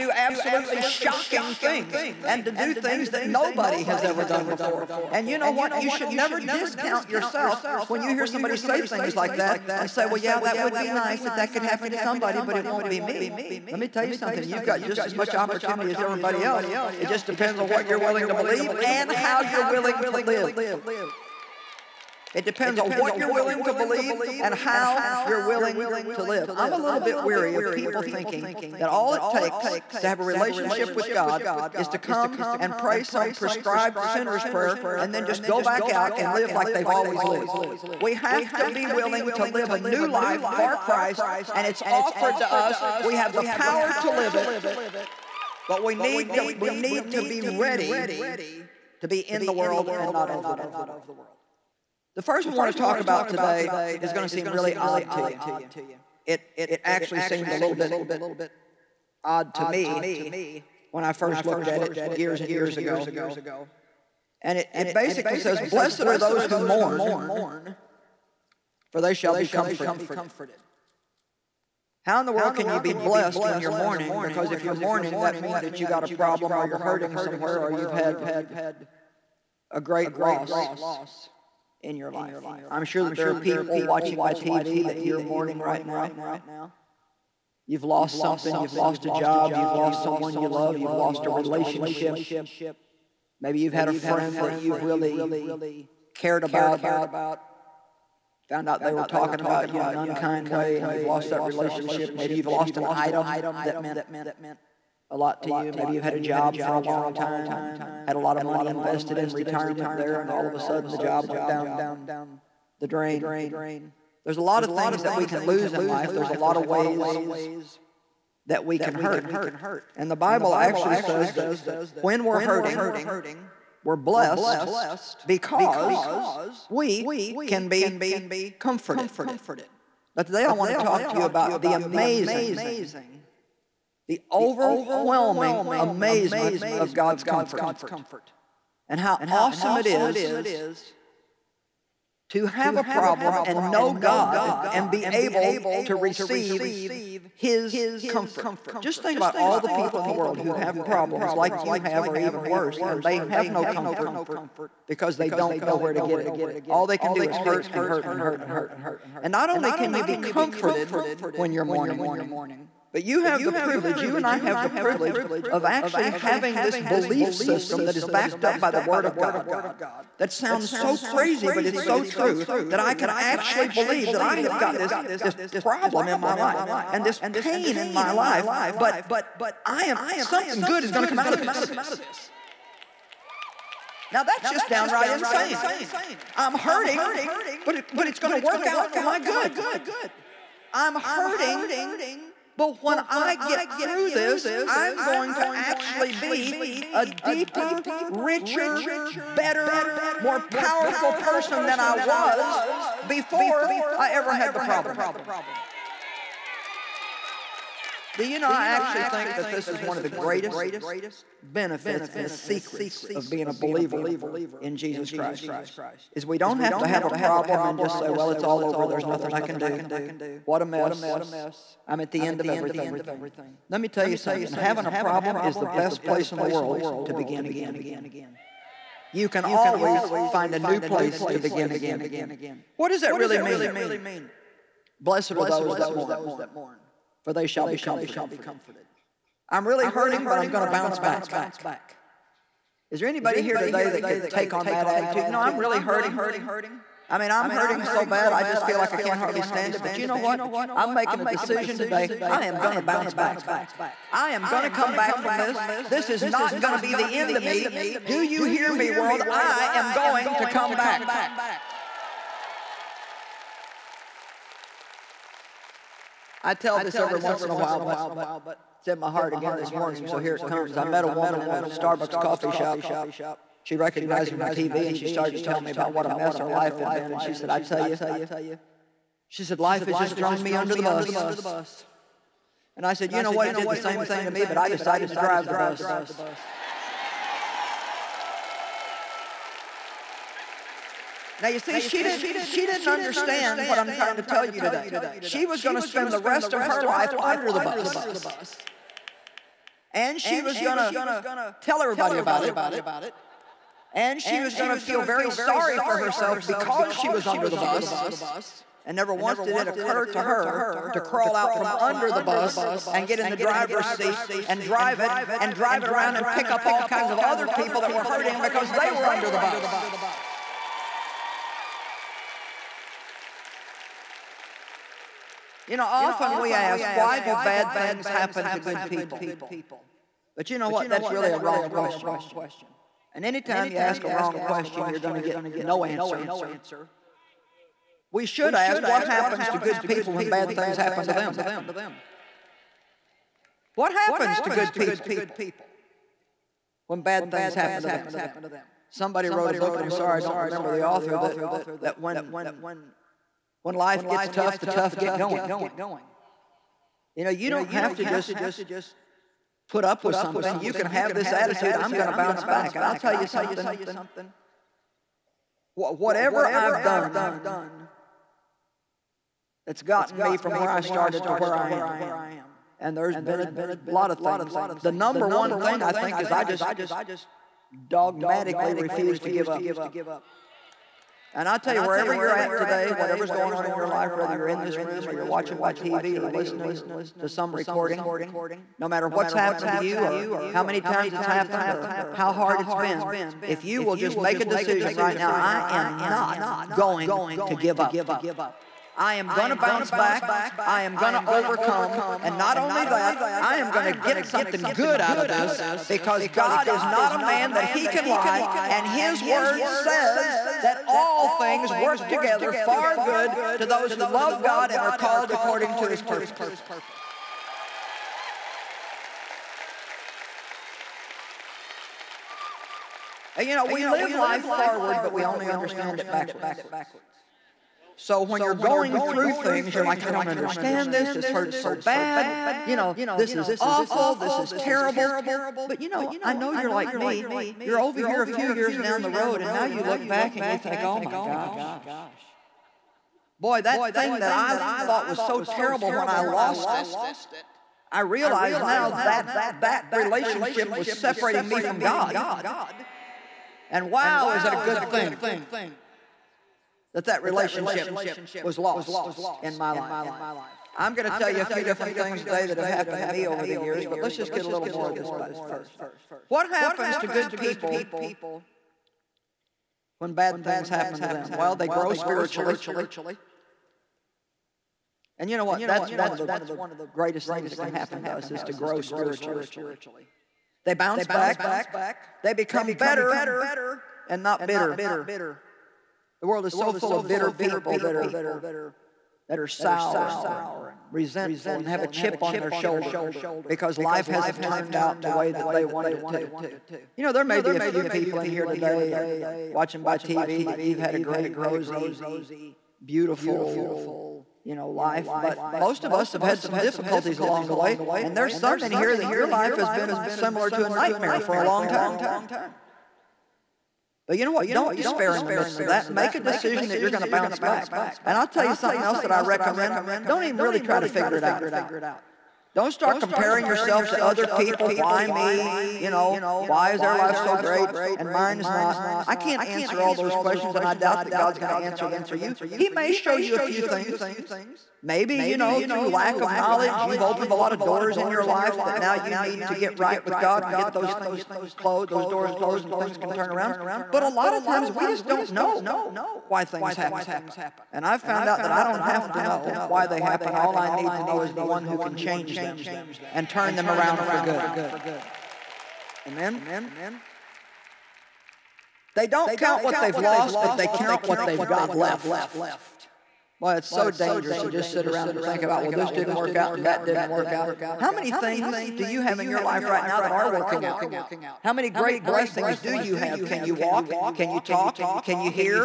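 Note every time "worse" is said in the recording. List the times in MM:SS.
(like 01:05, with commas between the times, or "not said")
02:32.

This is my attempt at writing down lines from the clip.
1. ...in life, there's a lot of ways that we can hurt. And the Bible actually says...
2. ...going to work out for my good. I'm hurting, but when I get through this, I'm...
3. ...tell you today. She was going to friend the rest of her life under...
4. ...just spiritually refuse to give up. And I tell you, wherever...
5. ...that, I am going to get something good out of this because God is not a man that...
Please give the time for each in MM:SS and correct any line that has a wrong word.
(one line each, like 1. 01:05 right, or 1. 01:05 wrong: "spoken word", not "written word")
1. 01:55 right
2. 03:08 right
3. 04:54 wrong: "spend", not "friend"
4. 06:16 wrong: "dogmatically", not "spiritually"
5. 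06:42 right.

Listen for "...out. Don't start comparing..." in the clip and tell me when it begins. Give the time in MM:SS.
08:41.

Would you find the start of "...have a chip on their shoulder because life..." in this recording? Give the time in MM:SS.
08:11.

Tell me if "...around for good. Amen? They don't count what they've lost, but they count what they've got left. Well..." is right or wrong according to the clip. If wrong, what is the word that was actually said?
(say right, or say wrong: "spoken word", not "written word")
right.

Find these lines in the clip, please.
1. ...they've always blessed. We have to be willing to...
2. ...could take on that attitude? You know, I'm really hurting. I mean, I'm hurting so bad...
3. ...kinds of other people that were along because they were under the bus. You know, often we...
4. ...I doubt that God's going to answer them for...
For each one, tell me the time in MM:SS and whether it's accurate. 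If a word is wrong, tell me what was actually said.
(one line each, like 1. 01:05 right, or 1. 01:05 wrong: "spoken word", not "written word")
1. 00:36 wrong: "lived", not "blessed"
2. 04:04 right
3. 05:16 wrong: "hurting", not "along"
4. 08:50 right.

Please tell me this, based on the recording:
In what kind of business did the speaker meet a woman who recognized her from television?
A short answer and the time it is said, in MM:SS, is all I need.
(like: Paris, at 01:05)
Starbucks coffee shop, at 04:31.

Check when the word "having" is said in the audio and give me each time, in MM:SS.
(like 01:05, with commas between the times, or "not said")
02:46, 03:44.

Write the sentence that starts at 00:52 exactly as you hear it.
The first we want to talk about today is going to seem really odd to you.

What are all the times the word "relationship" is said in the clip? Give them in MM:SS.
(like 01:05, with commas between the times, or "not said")
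00:30, 01:31, 01:41, 07:29, 07:37.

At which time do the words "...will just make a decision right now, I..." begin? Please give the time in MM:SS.
06:33.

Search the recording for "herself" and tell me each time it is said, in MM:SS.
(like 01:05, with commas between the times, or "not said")
05:05.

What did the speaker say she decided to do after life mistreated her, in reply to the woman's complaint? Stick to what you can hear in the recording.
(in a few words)
Drive the bus.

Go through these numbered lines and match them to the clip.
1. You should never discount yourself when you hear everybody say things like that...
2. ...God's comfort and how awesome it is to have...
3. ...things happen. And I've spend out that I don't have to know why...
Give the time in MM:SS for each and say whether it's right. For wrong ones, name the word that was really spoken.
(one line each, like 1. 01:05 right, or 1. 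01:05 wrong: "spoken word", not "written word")
1. 00:05 wrong: "somebody", not "everybody"
2. 02:16 right
3. 09:06 wrong: "found", not "spend".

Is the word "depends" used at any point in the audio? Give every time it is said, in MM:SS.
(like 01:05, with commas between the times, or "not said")
00:17, 00:22.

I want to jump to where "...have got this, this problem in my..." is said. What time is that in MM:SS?
02:54.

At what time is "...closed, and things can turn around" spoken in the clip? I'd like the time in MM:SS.
09:02.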